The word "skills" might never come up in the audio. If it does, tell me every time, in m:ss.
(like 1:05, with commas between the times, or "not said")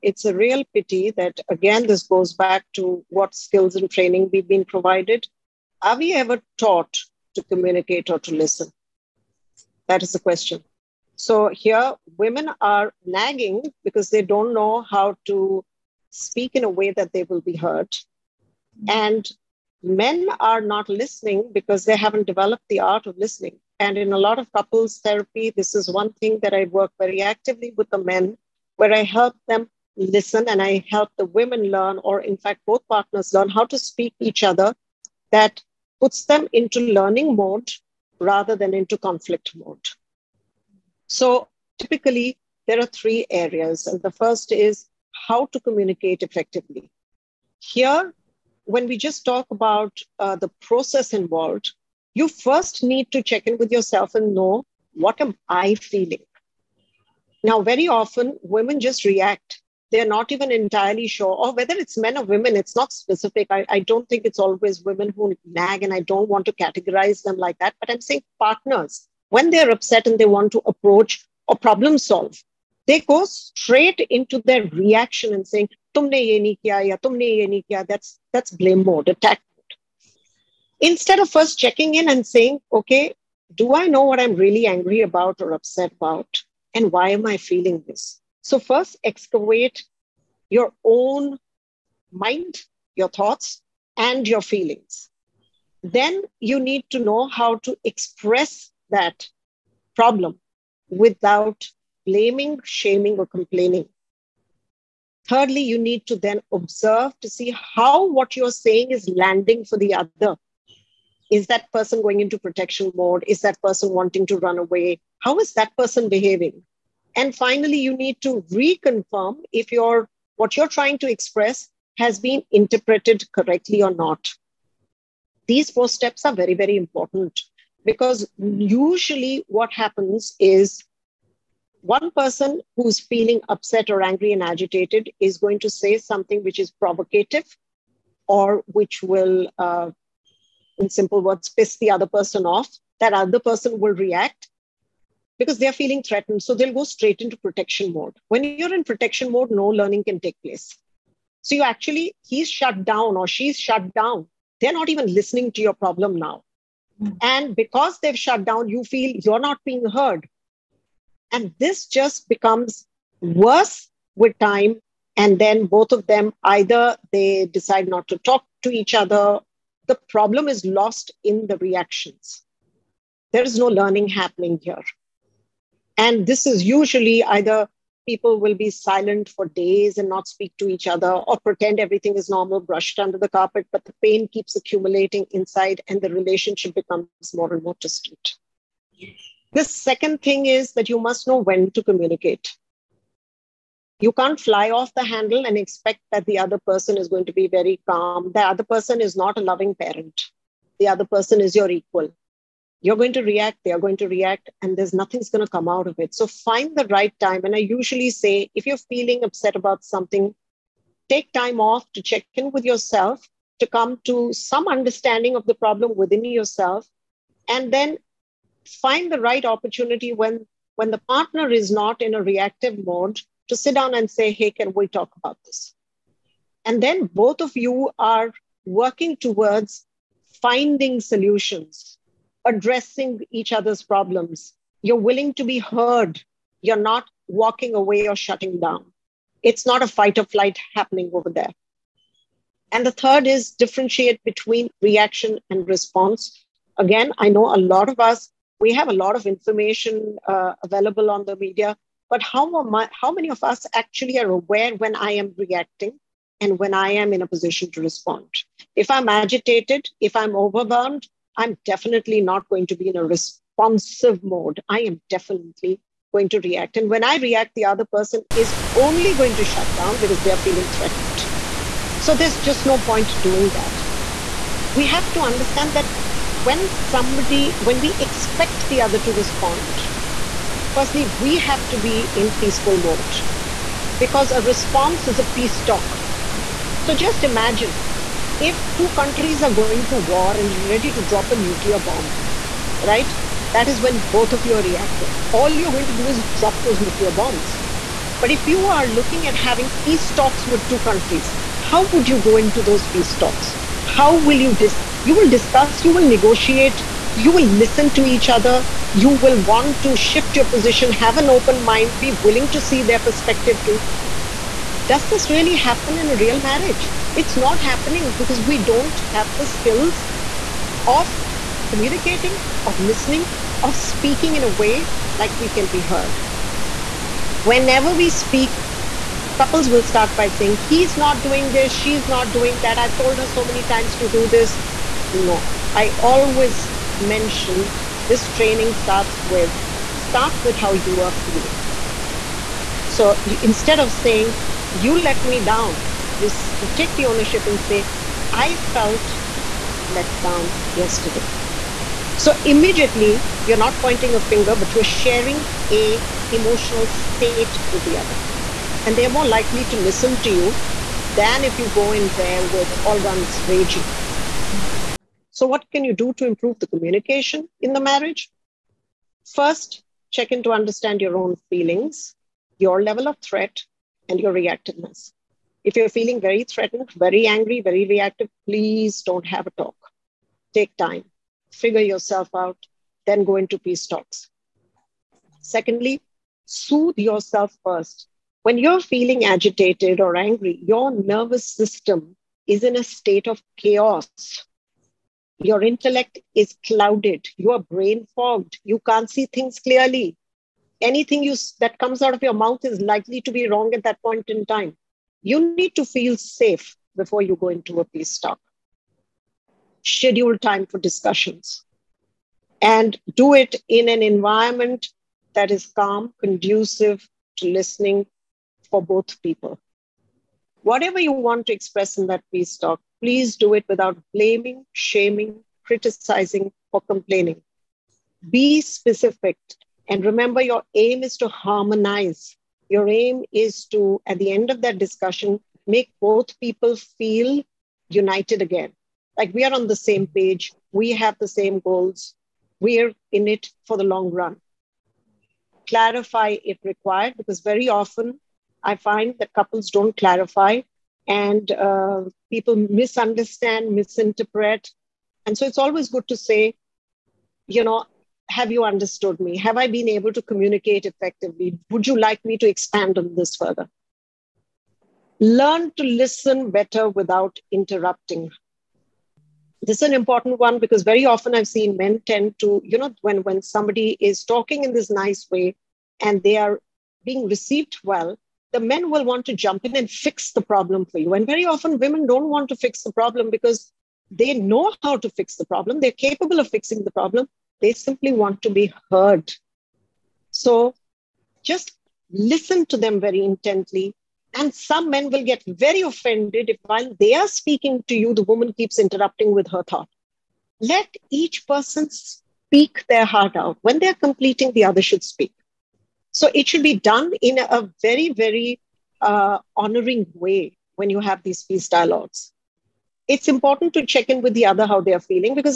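0:03, 5:19.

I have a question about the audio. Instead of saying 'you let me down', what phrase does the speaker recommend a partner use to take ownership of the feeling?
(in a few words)
I felt let down yesterday.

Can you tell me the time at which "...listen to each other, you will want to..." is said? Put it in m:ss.
5:07.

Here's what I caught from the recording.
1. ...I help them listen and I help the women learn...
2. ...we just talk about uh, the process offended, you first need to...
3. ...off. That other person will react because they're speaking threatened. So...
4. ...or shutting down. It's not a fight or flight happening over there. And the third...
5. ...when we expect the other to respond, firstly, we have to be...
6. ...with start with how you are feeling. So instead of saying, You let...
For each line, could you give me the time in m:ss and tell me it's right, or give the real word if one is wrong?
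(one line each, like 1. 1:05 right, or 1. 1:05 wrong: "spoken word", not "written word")
1. 0:28 right
2. 0:48 wrong: "involved", not "offended"
3. 2:22 wrong: "feeling", not "speaking"
4. 3:58 right
5. 4:37 right
6. 5:39 right.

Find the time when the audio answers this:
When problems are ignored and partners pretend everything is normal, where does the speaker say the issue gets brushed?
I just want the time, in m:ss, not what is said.
3:02.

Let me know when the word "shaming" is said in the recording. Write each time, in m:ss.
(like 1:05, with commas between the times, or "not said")
1:42, 7:04.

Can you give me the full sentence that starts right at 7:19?
Like we are on the same page, we have the same goals, we're in it for the long run.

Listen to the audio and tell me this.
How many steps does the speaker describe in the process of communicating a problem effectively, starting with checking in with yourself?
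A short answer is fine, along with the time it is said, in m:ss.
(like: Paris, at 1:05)
4, at 2:05.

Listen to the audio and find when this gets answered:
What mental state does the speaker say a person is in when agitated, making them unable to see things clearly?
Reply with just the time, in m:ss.
6:37.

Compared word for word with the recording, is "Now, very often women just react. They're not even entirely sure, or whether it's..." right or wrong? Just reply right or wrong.
right.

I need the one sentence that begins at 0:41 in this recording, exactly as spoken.
So typically, there are three areas.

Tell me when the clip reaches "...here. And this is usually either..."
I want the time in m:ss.
2:54.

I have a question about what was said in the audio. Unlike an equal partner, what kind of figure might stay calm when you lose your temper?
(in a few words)
a loving parent.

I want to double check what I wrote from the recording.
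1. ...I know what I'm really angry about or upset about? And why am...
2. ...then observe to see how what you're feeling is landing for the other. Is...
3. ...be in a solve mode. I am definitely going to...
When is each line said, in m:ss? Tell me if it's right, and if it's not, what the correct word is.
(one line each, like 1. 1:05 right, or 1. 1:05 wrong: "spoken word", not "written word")
1. 1:23 right
2. 1:46 wrong: "saying", not "feeling"
3. 4:22 wrong: "responsive", not "solve".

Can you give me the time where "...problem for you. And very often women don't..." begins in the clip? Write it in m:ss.
8:00.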